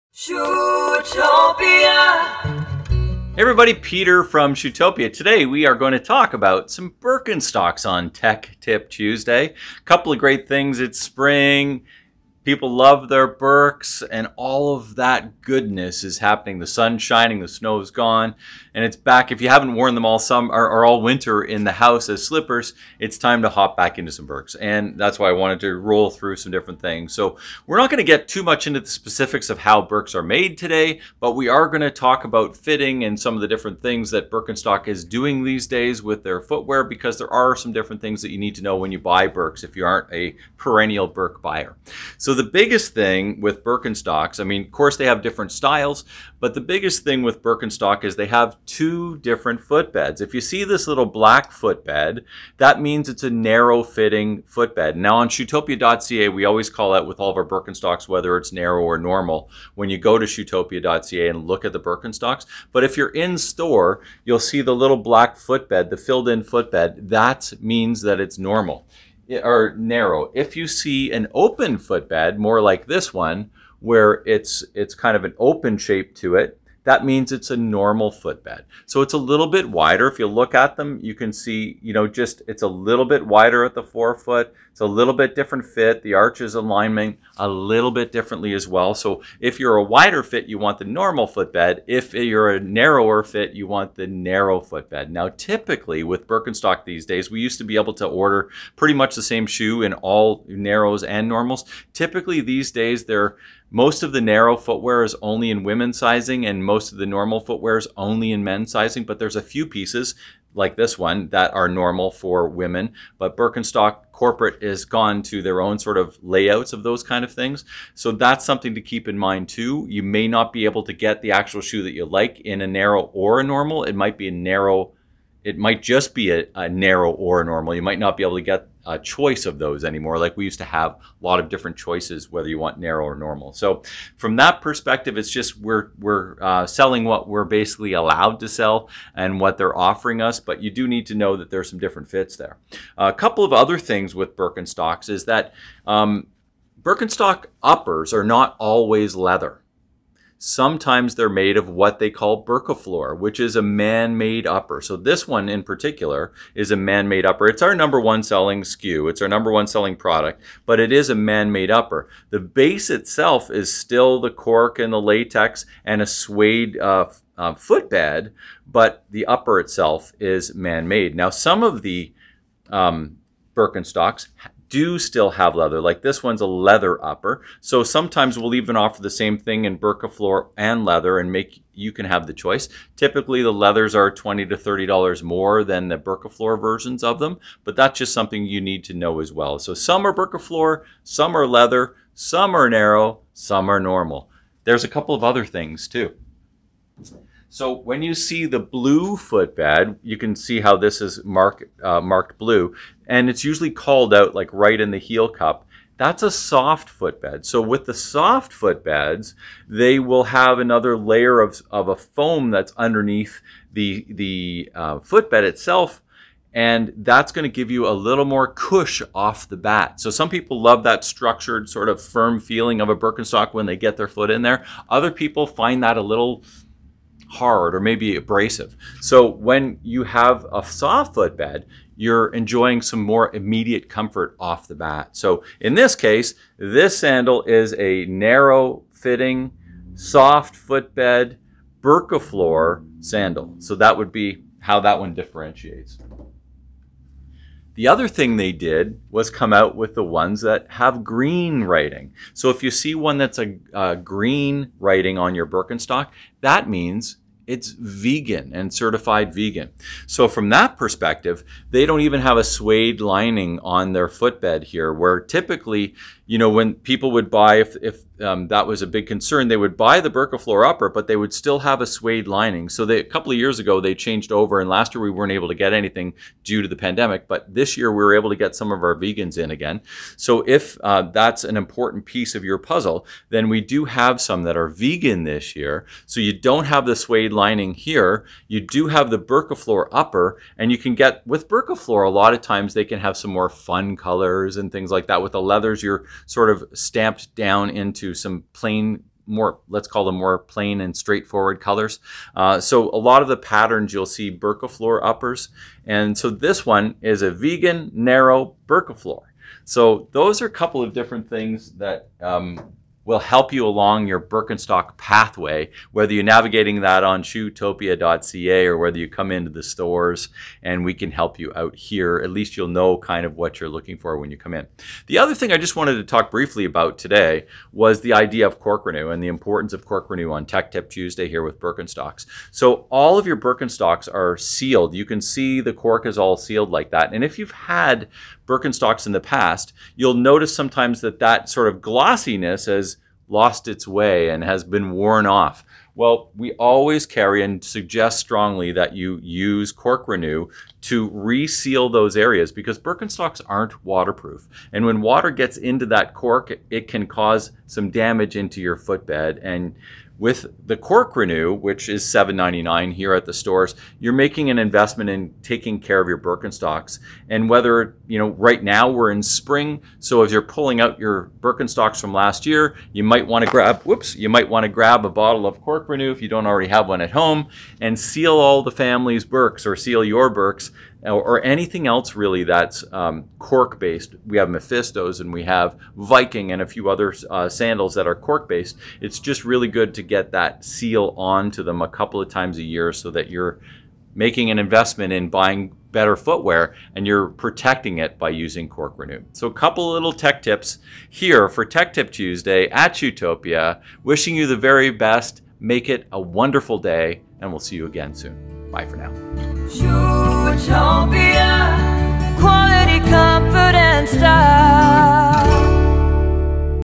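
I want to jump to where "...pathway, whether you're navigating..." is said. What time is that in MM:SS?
05:14.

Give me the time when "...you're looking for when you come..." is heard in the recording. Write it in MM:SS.
05:23.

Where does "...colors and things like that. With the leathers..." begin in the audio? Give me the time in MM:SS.
04:53.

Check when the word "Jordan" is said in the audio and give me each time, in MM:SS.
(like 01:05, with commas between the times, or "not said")
not said.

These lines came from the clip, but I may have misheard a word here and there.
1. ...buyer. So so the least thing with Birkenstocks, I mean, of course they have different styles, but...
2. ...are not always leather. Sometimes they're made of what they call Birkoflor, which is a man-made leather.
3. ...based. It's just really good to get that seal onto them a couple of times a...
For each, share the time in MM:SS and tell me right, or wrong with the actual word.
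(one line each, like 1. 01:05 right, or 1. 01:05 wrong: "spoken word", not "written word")
1. 00:41 wrong: "biggest", not "least"
2. 02:28 wrong: "upper", not "leather"
3. 06:28 right.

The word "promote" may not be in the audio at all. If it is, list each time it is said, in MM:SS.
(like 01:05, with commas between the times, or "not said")
not said.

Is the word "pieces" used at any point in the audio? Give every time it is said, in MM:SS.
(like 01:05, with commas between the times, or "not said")
01:49, 04:42.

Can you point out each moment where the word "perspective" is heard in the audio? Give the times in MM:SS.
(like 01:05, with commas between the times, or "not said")
02:14, 04:20.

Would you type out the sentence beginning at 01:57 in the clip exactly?
So that's something to keep in mind too.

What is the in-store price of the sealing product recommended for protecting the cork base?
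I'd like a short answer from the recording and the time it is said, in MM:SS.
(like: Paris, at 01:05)
$7.99, at 06:02.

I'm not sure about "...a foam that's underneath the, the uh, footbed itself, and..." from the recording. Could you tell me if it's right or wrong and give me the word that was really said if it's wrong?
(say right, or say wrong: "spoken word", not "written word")
right.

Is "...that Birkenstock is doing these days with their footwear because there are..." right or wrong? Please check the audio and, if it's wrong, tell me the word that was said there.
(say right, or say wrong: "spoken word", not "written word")
right.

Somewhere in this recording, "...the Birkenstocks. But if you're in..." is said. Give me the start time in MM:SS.
01:01.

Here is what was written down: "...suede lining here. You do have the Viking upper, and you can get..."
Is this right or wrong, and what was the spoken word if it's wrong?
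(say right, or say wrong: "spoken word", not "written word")
wrong: "Birkoflor", not "Viking".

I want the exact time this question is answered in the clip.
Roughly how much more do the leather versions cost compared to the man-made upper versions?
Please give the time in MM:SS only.
03:04.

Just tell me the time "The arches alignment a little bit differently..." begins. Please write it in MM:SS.
01:26.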